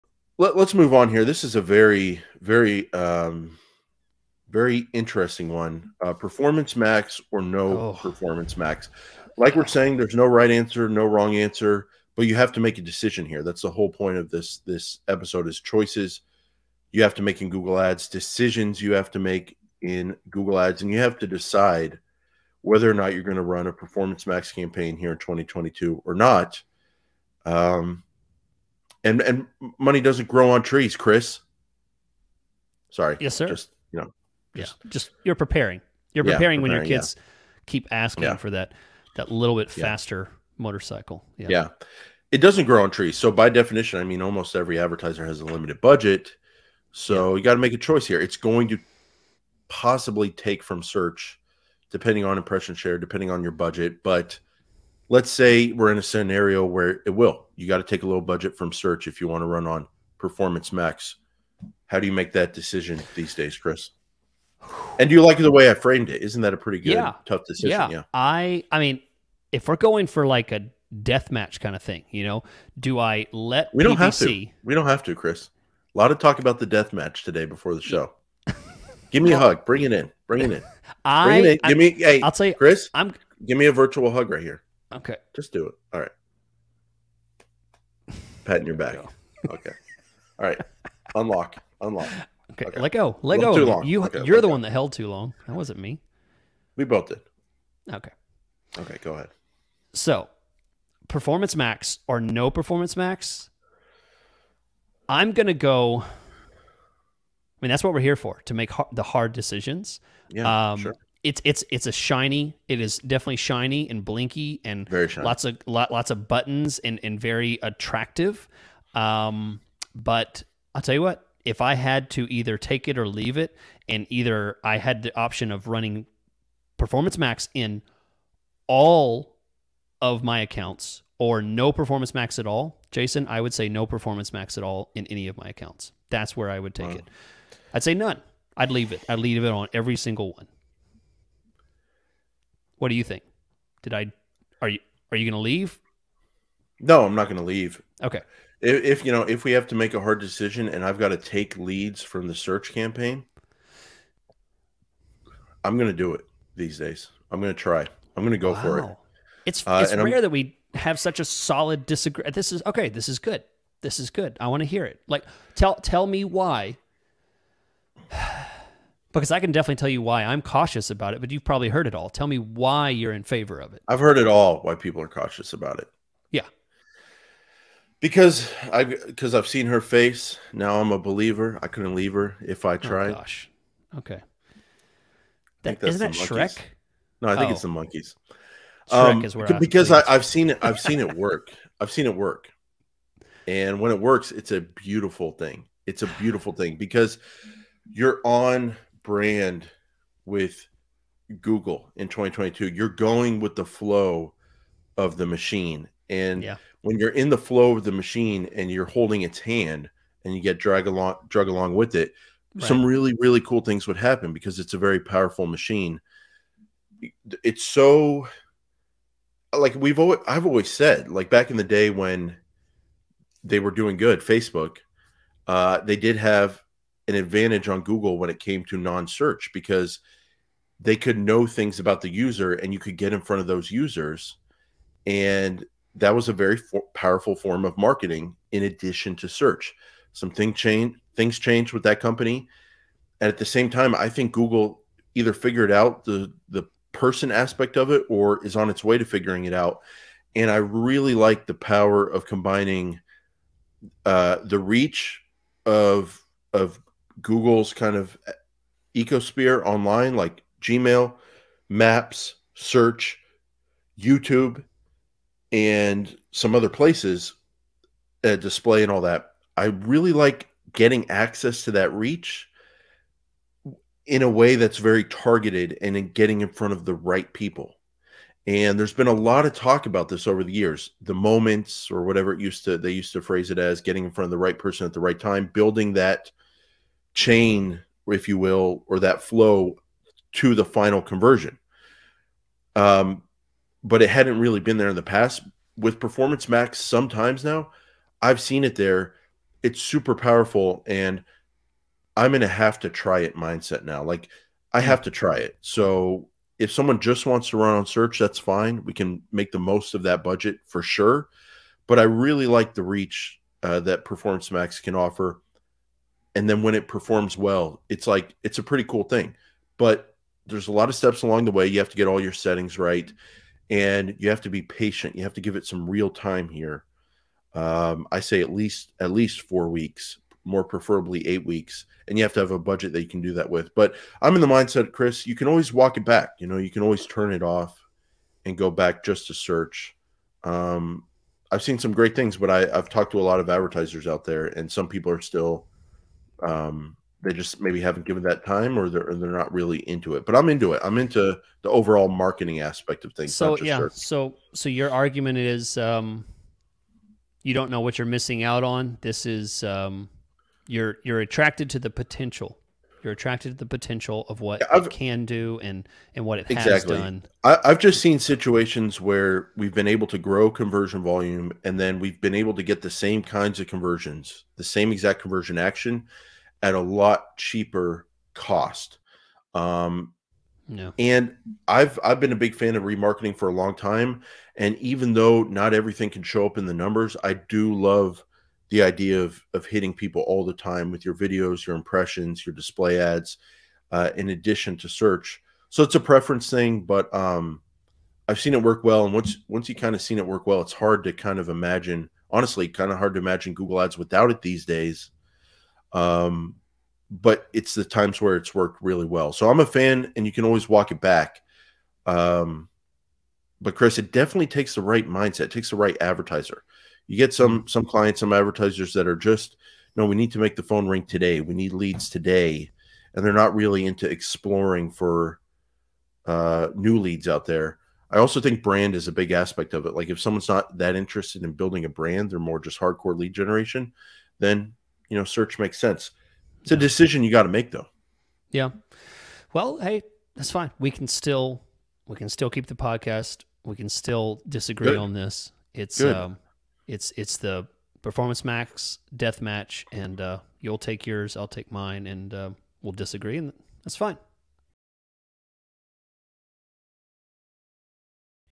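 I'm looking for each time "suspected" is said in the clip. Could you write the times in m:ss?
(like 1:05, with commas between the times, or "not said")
not said.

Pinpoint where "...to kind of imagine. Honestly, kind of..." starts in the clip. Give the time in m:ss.
6:41.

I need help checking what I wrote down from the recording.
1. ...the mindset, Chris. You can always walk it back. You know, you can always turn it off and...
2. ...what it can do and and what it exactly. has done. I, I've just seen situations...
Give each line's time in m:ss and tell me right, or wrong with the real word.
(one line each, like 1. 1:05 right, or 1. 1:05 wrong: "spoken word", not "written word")
1. 5:34 right
2. 6:04 right.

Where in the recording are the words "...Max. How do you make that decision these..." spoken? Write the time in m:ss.
1:00.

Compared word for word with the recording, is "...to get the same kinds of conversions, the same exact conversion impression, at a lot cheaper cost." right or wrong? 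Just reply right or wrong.
wrong.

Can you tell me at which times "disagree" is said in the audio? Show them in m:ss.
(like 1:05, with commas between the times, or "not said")
2:41, 7:24, 7:32.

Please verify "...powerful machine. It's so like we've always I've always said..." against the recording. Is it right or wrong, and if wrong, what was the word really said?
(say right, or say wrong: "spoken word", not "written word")
right.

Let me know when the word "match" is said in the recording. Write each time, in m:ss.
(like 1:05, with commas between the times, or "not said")
1:11, 1:16, 7:29.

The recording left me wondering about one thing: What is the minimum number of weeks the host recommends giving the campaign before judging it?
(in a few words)
4.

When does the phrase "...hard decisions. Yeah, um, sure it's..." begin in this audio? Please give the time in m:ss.
1:49.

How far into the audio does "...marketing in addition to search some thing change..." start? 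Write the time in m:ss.
3:57.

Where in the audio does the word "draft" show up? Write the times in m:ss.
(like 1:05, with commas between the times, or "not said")
not said.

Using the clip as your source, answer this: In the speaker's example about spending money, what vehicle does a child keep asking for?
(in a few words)
motorcycle.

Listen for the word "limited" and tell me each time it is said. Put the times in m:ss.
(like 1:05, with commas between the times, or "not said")
0:45.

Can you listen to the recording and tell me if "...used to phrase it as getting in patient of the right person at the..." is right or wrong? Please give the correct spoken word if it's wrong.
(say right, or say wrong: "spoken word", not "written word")
wrong: "front", not "patient".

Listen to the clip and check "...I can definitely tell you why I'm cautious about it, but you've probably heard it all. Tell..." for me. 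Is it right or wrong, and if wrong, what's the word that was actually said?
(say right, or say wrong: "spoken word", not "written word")
right.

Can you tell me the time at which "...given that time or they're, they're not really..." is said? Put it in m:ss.
5:48.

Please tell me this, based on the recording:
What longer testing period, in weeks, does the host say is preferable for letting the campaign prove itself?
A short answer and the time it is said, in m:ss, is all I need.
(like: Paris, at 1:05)
8, at 5:31.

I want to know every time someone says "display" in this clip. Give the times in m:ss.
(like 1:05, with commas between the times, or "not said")
4:28, 6:32.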